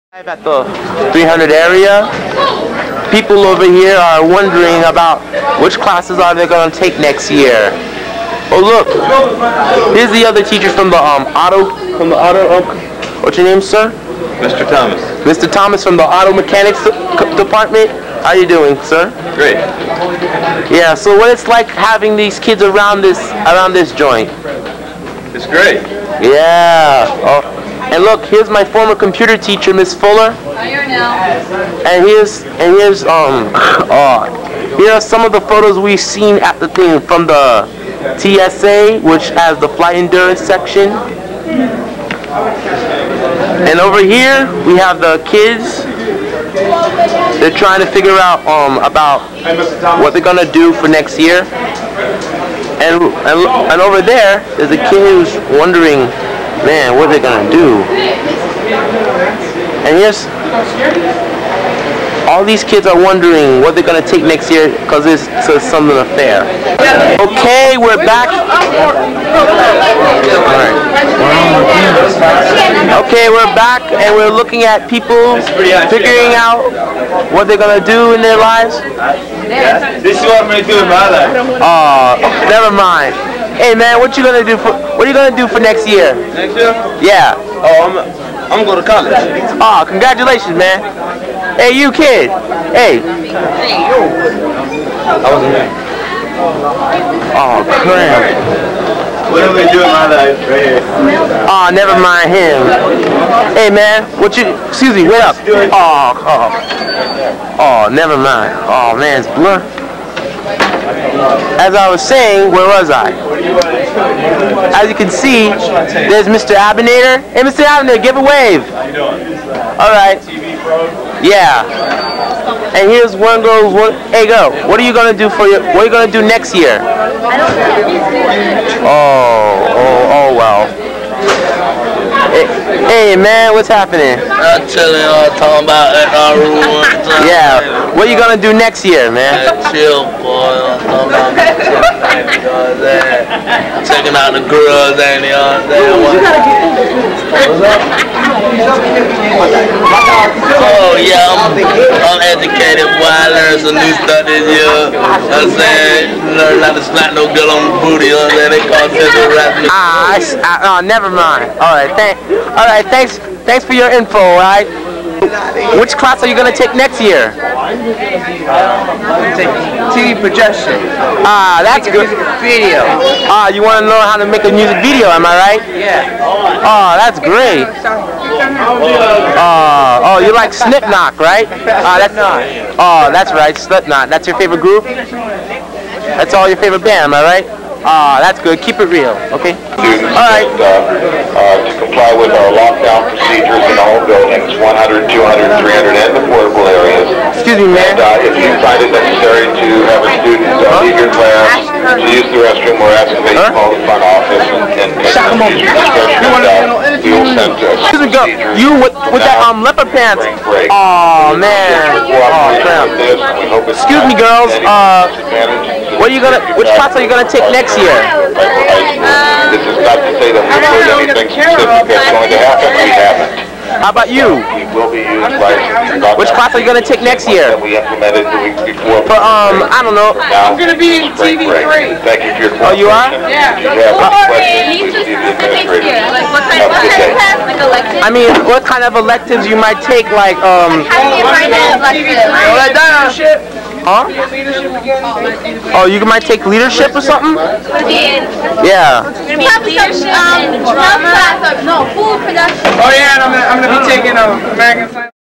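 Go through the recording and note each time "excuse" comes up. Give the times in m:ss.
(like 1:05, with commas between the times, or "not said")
1:44, 3:17, 3:27, 3:33.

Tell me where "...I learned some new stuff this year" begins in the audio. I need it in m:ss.
2:33.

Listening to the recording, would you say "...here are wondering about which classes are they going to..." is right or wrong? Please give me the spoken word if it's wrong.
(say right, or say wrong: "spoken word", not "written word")
right.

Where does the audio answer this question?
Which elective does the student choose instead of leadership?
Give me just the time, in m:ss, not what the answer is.
4:11.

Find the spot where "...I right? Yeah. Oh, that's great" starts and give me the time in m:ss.
2:55.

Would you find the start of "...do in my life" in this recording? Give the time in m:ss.
1:20.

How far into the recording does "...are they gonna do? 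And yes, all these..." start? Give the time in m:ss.
0:57.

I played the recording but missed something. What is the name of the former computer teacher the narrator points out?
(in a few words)
Miss Fuller.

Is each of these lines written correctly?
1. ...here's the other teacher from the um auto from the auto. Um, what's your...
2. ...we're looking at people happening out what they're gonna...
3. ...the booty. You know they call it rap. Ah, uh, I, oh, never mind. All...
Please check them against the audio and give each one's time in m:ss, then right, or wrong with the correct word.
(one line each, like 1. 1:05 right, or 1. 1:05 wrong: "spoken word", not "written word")
1. 0:09 right
2. 1:14 wrong: "figuring", not "happening"
3. 2:37 right.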